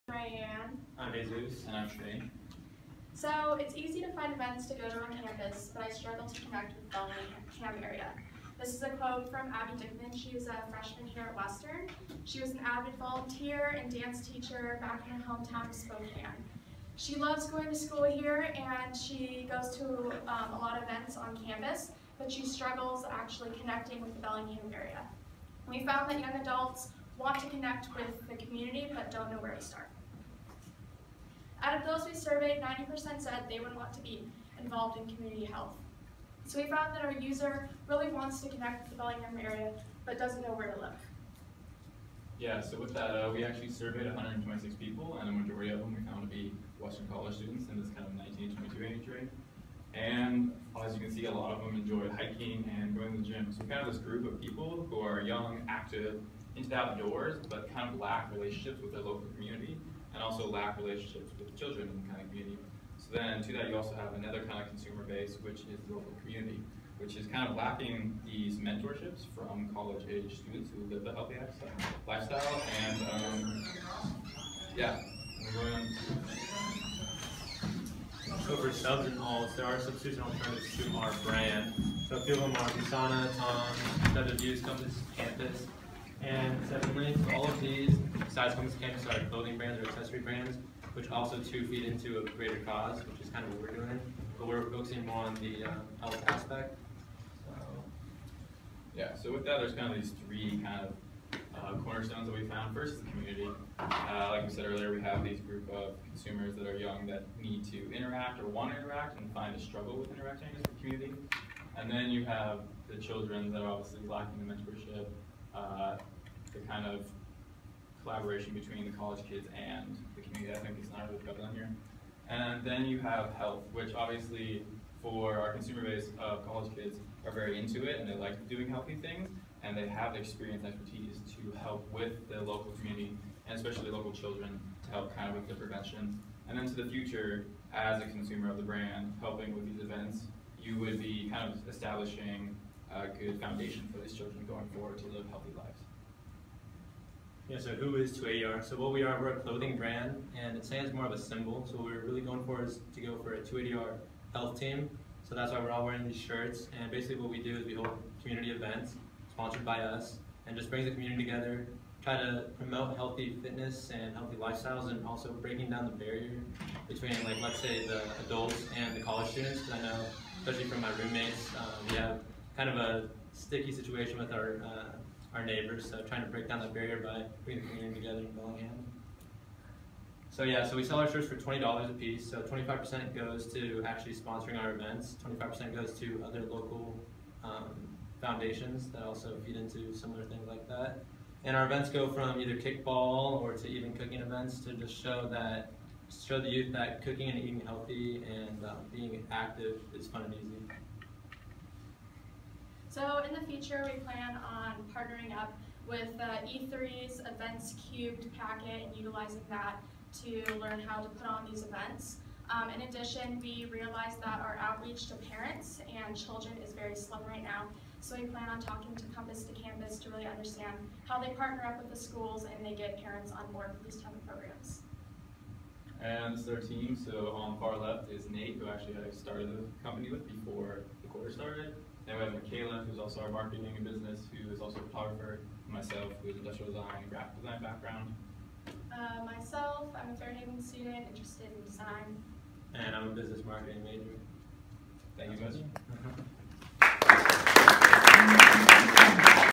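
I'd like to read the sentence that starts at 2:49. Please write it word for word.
Because I know, especially from my roommates, um, we have kind of a sticky situation with our uh, our neighbors.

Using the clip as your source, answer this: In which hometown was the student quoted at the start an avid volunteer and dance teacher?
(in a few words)
Spokane.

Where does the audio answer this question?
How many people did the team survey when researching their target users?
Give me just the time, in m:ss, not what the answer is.
0:44.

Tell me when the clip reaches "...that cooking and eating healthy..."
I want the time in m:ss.
3:16.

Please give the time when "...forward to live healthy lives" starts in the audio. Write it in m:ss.
2:24.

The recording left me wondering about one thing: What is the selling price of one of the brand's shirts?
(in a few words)
$20.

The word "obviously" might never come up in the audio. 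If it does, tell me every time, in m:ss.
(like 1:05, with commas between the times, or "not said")
1:53, 2:03.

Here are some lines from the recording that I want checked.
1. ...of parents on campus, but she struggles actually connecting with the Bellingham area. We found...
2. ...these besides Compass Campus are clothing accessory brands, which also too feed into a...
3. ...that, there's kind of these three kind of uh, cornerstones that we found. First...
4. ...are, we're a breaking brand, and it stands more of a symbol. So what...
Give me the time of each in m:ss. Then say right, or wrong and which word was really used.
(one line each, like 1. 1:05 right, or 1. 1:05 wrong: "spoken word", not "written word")
1. 0:20 wrong: "events", not "parents"
2. 1:27 right
3. 1:39 right
4. 2:29 wrong: "clothing", not "breaking".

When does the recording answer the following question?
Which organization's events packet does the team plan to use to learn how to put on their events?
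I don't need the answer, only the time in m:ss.
3:26.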